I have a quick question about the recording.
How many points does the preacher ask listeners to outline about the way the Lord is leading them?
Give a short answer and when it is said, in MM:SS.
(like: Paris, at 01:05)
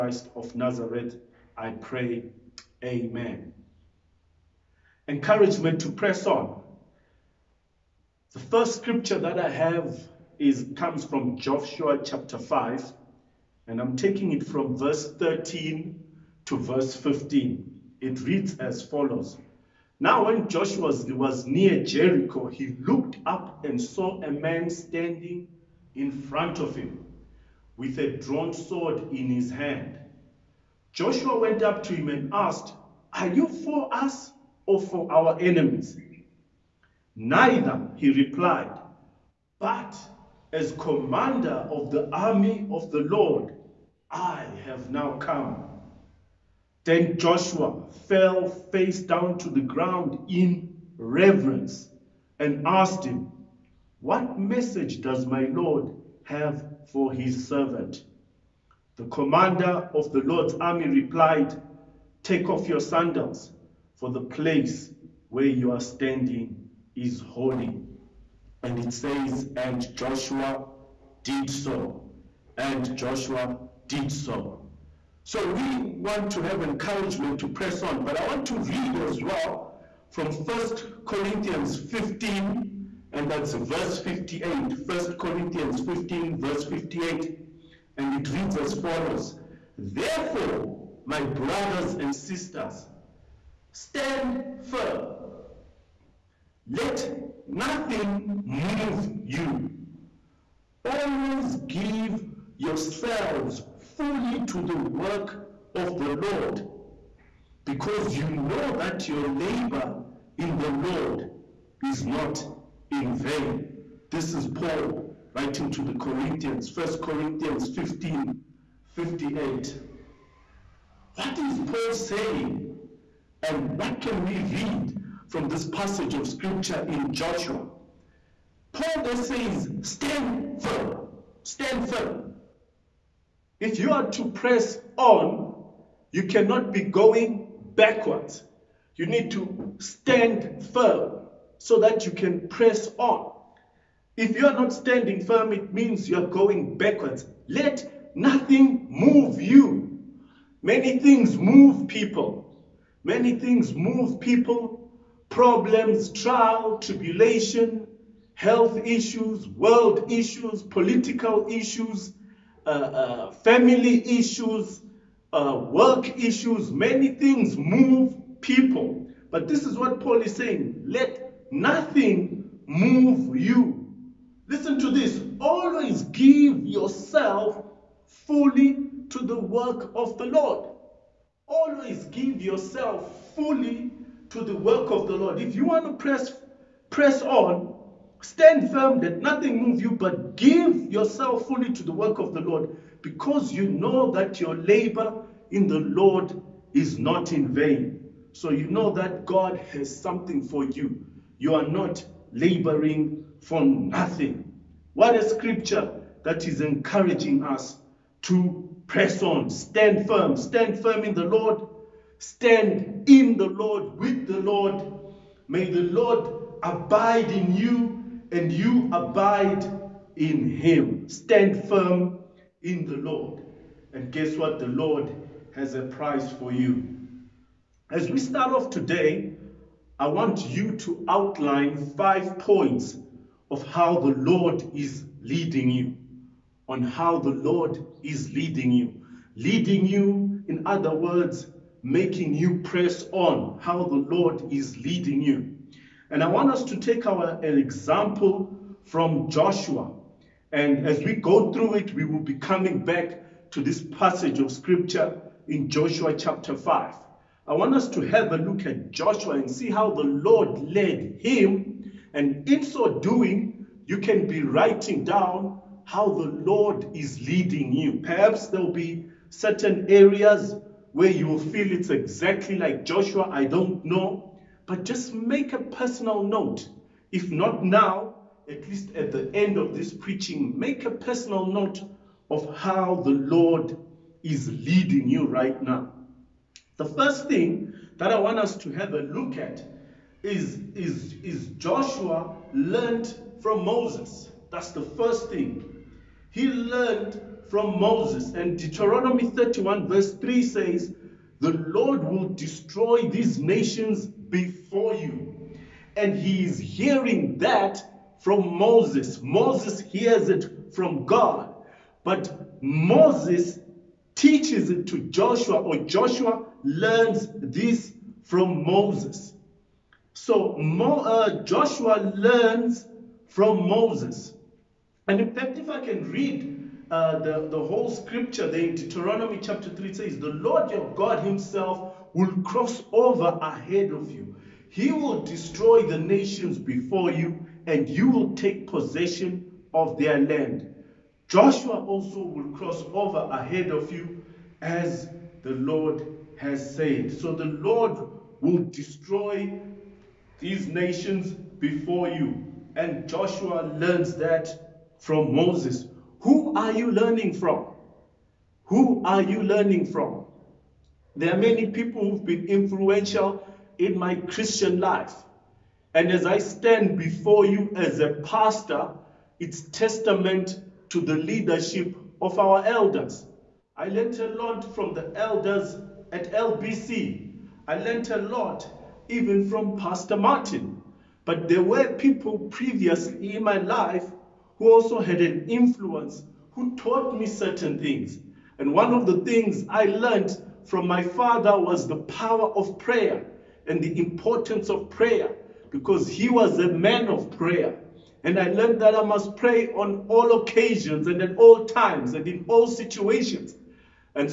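5, at 03:51.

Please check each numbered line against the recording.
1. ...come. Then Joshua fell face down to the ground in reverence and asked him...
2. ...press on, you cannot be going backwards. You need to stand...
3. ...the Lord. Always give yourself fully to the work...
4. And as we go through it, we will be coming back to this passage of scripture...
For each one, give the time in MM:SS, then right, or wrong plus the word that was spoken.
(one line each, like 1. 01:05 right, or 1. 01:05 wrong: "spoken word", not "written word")
1. 00:45 right
2. 02:14 right
3. 03:00 right
4. 04:10 right.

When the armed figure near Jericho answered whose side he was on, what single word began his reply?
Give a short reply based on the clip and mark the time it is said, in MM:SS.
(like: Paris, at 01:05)
Neither, at 00:37.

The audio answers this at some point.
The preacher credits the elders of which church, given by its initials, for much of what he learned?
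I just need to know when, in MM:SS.
06:16.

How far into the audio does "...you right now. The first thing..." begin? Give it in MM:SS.
04:45.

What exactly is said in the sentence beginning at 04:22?
And in so doing, you can be writing down how the Lord is leading you.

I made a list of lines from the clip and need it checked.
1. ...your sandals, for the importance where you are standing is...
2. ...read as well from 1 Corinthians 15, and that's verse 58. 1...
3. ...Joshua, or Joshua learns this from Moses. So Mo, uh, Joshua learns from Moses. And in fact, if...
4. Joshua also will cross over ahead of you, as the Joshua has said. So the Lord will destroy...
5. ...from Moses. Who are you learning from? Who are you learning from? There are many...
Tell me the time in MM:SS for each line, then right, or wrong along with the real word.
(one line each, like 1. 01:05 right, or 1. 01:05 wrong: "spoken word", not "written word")
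1. 01:02 wrong: "place", not "importance"
2. 01:18 right
3. 05:14 right
4. 05:41 wrong: "Lord", not "Joshua"
5. 05:54 right.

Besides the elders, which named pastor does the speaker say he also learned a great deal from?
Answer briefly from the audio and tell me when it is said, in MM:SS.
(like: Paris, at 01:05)
Pastor Martin, at 06:19.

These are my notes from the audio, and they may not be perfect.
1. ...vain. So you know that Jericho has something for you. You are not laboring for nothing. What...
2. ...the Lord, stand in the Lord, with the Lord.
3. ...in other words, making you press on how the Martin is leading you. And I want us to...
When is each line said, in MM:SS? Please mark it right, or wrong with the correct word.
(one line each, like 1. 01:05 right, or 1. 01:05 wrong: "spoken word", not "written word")
1. 03:17 wrong: "God", not "Jericho"
2. 03:31 right
3. 04:00 wrong: "Lord", not "Martin".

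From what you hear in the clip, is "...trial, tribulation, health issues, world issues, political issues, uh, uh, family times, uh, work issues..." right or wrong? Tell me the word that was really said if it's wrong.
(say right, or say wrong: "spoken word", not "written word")
wrong: "issues", not "times".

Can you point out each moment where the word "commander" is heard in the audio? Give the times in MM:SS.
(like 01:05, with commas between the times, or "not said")
00:40, 00:59.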